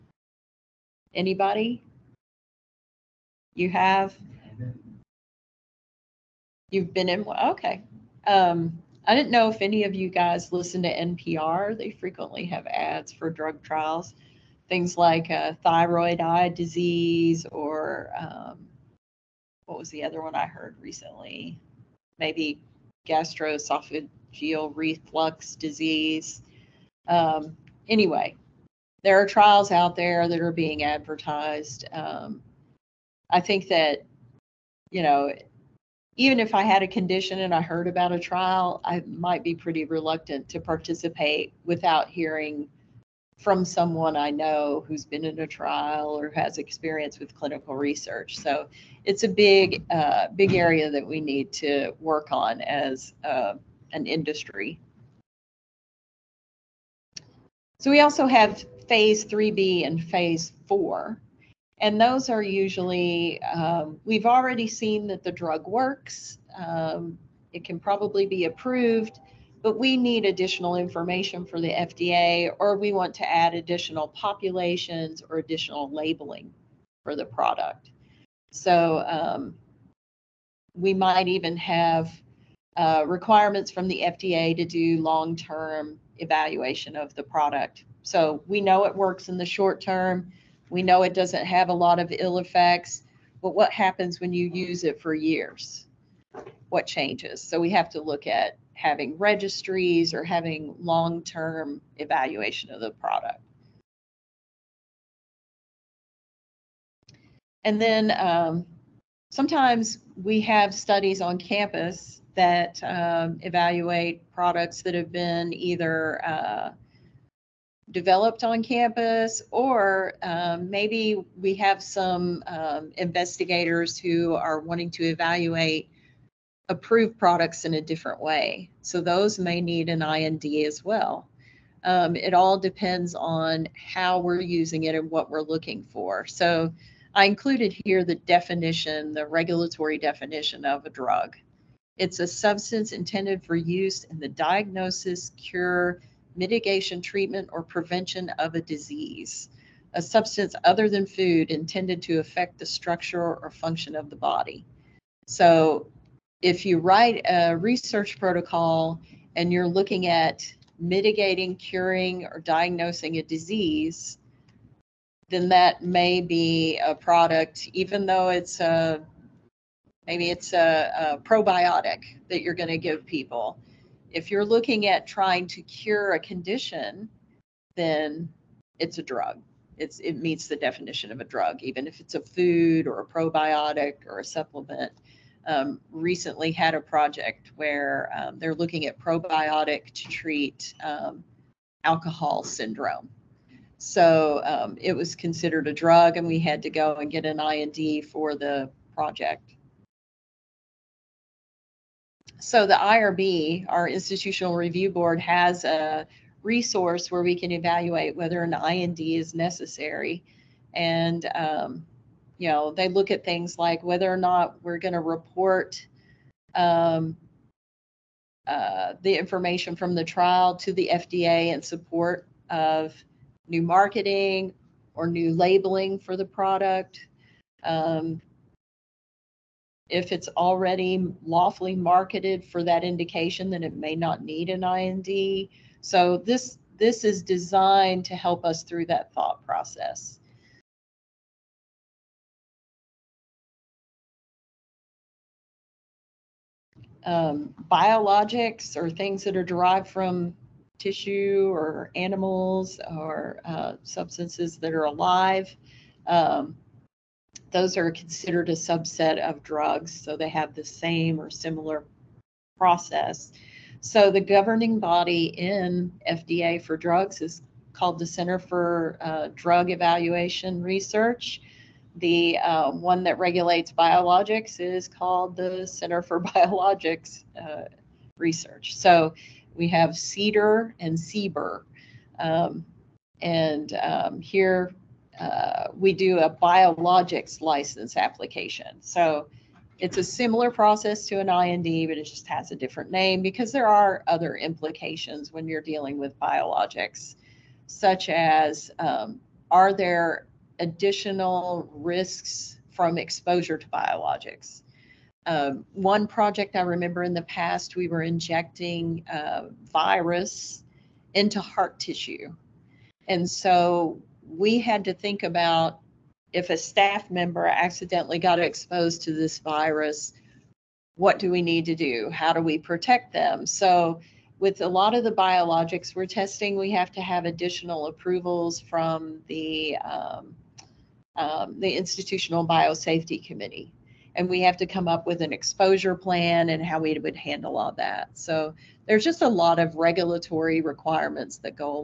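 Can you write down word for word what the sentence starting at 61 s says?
And those are usually, um, we've already seen that the drug works.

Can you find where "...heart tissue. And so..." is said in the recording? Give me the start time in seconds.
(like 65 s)
311 s.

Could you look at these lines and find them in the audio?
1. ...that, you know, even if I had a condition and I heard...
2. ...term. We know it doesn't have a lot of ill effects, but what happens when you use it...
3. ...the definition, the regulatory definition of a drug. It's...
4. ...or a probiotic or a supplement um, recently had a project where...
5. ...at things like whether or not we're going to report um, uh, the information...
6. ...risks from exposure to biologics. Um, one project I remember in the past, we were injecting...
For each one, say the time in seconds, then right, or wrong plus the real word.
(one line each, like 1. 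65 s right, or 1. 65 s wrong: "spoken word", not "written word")
1. 33 s right
2. 89 s right
3. 138 s right
4. 182 s right
5. 213 s right
6. 301 s right.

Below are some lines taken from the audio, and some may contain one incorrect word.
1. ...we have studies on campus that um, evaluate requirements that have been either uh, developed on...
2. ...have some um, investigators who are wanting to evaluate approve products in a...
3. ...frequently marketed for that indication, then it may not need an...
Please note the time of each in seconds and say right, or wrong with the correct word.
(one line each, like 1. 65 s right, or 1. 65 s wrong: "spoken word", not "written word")
1. 110 s wrong: "products", not "requirements"
2. 121 s right
3. 231 s wrong: "lawfully", not "frequently".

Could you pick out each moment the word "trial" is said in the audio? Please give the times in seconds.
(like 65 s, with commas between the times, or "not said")
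13 s, 29 s, 38 s, 45 s, 220 s.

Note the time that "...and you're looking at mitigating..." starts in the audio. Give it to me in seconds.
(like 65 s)
159 s.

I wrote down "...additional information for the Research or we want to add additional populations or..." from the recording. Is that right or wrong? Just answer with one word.
wrong.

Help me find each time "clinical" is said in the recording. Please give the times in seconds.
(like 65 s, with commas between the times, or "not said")
47 s.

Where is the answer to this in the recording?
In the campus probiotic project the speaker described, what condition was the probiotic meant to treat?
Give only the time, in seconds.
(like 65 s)
191 s.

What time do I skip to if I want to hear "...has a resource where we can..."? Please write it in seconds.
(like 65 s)
205 s.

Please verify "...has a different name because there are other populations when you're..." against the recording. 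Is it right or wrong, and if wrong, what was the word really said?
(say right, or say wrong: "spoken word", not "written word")
wrong: "implications", not "populations".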